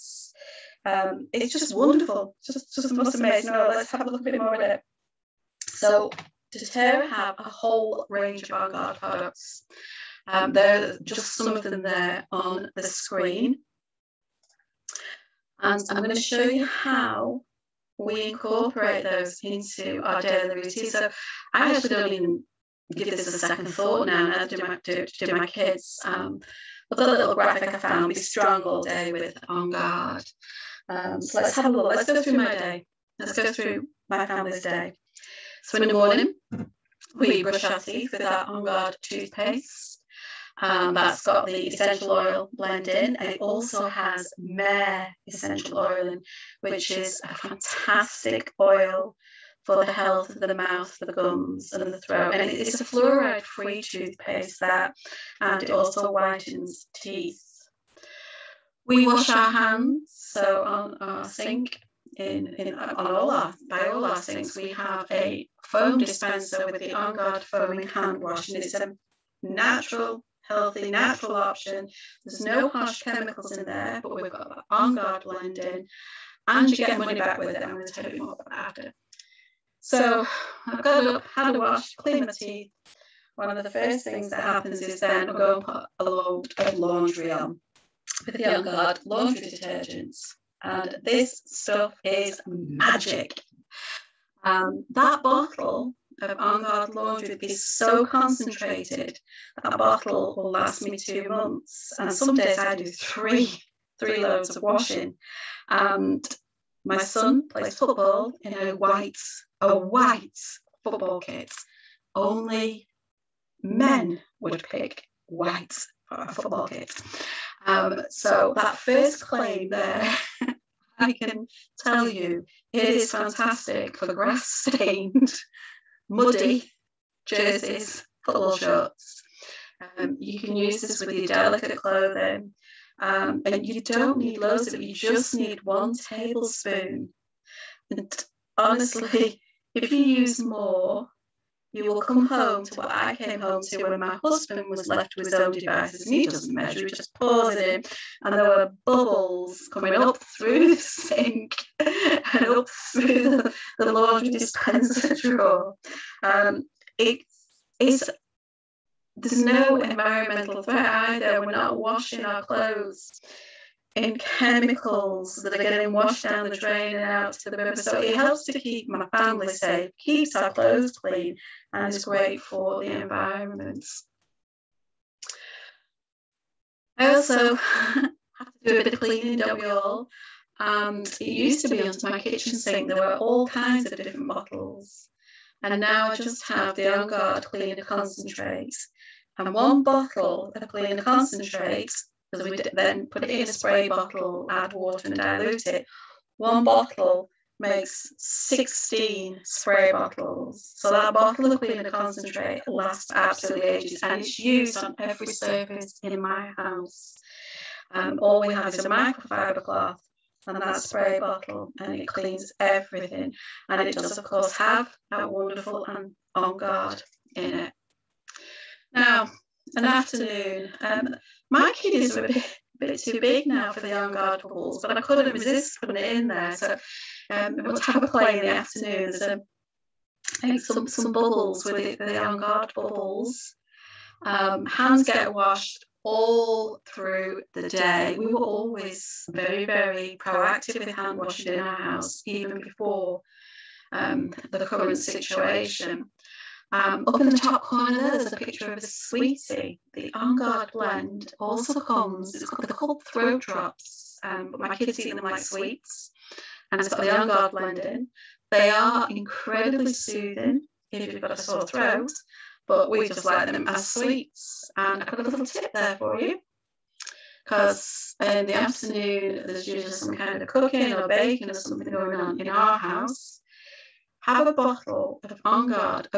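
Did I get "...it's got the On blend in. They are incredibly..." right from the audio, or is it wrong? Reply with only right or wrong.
right.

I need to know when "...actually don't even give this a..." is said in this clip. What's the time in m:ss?
0:21.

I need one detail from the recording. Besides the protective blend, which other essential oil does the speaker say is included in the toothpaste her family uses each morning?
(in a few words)
Myrrh.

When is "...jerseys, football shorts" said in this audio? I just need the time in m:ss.
2:07.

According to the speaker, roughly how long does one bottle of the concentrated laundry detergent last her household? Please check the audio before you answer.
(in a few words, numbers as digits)
2 months.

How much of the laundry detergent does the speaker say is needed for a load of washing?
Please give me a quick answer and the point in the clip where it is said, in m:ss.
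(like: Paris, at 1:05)
1 tablespoon, at 2:15.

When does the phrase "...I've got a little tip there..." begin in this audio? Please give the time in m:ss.
4:25.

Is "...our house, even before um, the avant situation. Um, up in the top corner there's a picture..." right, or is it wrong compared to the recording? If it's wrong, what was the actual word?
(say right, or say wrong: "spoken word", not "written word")
wrong: "current", not "avant".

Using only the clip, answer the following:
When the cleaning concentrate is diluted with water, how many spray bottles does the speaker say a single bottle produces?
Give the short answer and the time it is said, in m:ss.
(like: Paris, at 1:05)
16, at 3:18.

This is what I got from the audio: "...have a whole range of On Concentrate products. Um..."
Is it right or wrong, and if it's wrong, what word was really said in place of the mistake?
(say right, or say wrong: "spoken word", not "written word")
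wrong: "Guard", not "Concentrate".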